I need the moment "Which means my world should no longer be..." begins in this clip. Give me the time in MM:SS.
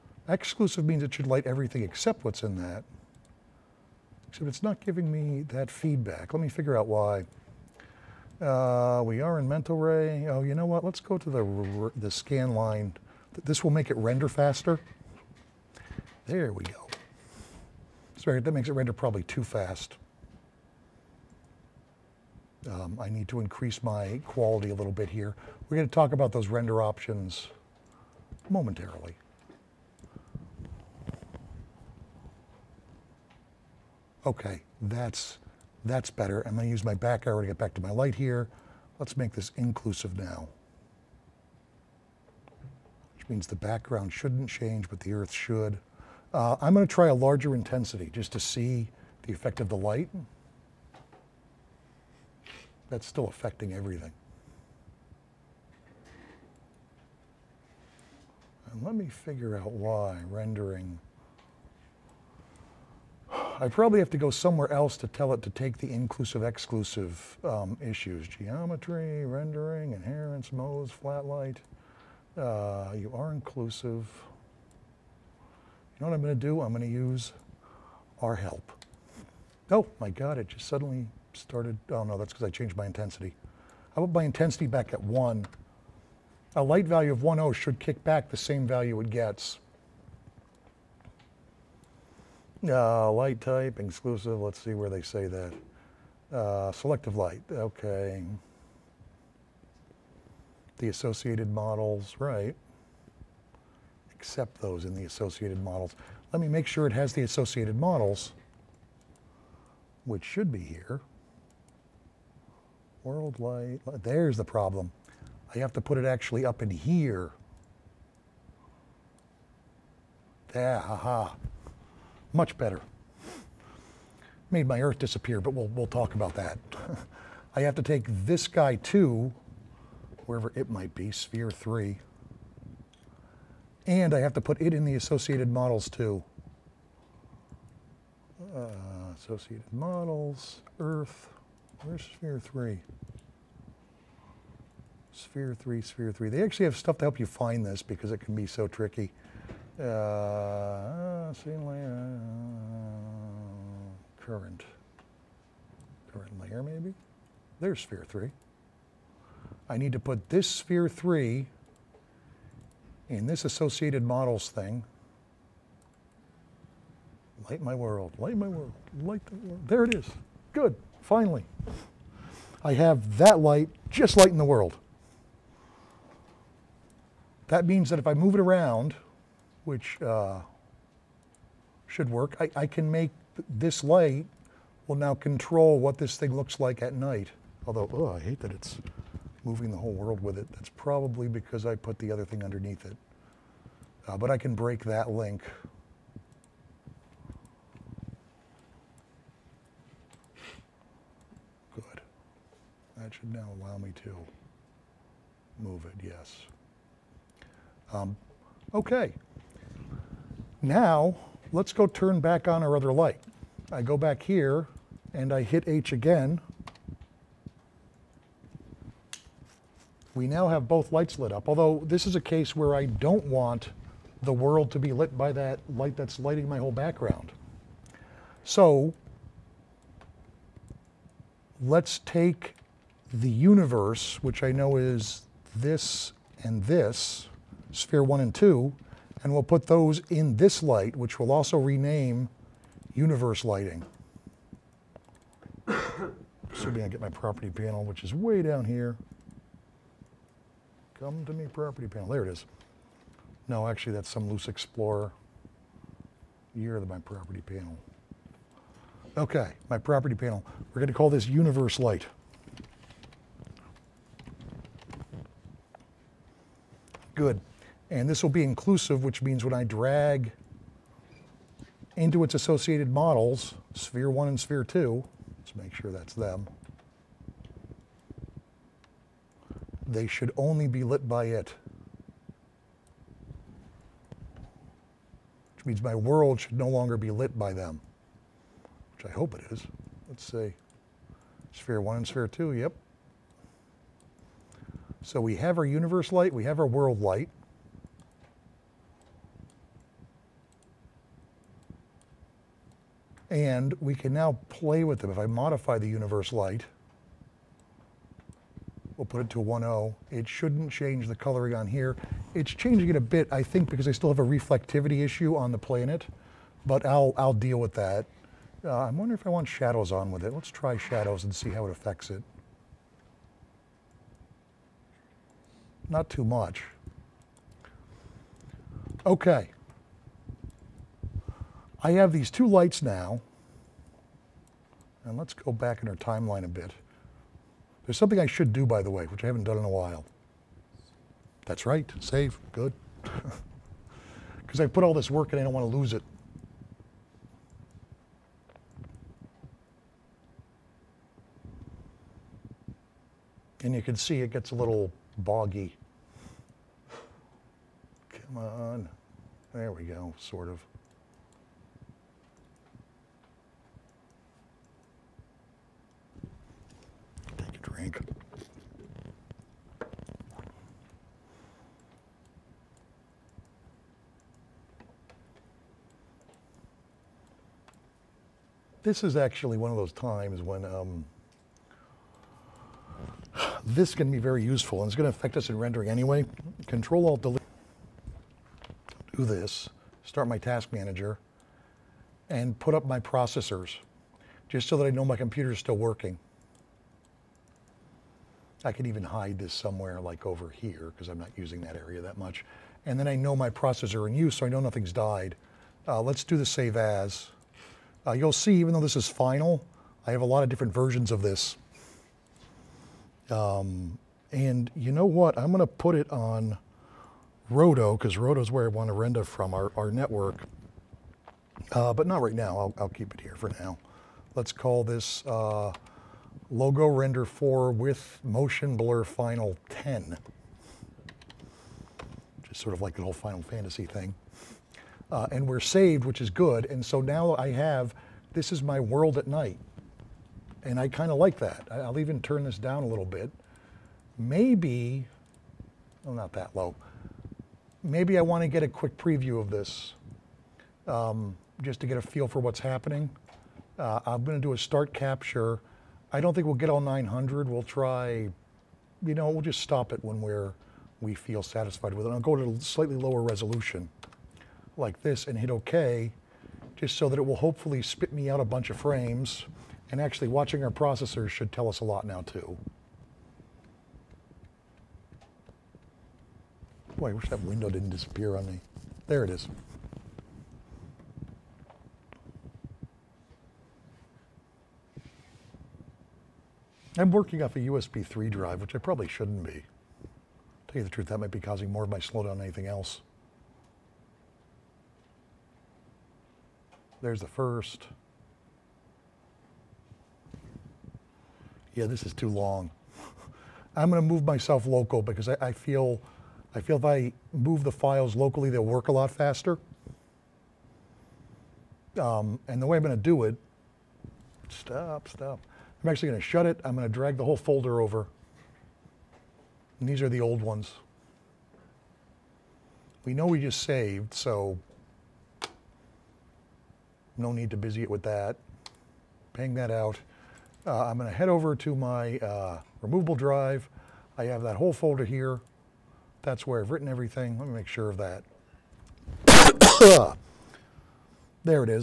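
04:45.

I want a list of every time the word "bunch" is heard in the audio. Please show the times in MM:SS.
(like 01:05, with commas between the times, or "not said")
07:48.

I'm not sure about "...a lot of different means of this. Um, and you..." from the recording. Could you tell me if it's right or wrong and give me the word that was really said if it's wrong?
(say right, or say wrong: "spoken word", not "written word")
wrong: "versions", not "means".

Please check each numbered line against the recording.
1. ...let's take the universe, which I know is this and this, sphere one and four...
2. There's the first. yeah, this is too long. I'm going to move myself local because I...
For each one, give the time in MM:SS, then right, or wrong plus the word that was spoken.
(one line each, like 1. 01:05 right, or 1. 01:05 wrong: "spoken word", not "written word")
1. 03:51 wrong: "two", not "four"
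2. 08:17 right.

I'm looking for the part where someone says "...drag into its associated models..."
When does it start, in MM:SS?
04:29.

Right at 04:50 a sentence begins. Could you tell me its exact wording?
Let's see, sphere one and sphere two, yep, so we have our universe light, we have our world light.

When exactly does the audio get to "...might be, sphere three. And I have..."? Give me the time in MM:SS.
02:10.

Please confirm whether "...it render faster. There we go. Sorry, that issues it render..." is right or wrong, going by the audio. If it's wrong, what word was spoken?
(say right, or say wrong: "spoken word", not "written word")
wrong: "makes", not "issues".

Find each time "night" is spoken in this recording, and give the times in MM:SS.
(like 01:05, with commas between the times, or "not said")
03:06, 07:19.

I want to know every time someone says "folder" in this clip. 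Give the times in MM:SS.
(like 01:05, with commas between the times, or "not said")
08:37, 08:54.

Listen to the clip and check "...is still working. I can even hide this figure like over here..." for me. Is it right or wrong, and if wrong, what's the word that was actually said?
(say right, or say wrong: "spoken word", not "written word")
wrong: "somewhere", not "figure".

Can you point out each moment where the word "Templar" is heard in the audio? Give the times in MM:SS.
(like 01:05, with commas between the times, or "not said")
not said.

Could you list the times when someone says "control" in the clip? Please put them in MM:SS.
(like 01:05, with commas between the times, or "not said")
03:05, 06:26.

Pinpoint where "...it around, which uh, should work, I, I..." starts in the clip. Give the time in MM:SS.
02:58.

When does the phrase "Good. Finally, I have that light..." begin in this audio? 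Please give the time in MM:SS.
02:50.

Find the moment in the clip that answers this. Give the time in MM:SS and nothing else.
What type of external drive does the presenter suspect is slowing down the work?
08:07.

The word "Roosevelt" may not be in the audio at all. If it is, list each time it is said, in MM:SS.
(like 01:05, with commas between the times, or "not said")
not said.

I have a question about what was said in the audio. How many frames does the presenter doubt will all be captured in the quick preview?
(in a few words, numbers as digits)
900.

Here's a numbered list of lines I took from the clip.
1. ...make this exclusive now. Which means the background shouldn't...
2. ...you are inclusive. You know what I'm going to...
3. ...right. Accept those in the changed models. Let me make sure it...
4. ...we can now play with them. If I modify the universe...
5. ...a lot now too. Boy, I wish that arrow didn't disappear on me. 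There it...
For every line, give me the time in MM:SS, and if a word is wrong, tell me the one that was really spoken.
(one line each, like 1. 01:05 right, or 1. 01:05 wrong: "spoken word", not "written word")
1. 00:39 wrong: "inclusive", not "exclusive"
2. 01:12 right
3. 01:42 wrong: "associated", not "changed"
4. 05:03 right
5. 07:51 wrong: "window", not "arrow".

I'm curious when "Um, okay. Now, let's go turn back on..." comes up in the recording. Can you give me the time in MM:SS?
03:27.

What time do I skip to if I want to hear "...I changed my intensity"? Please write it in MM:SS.
01:22.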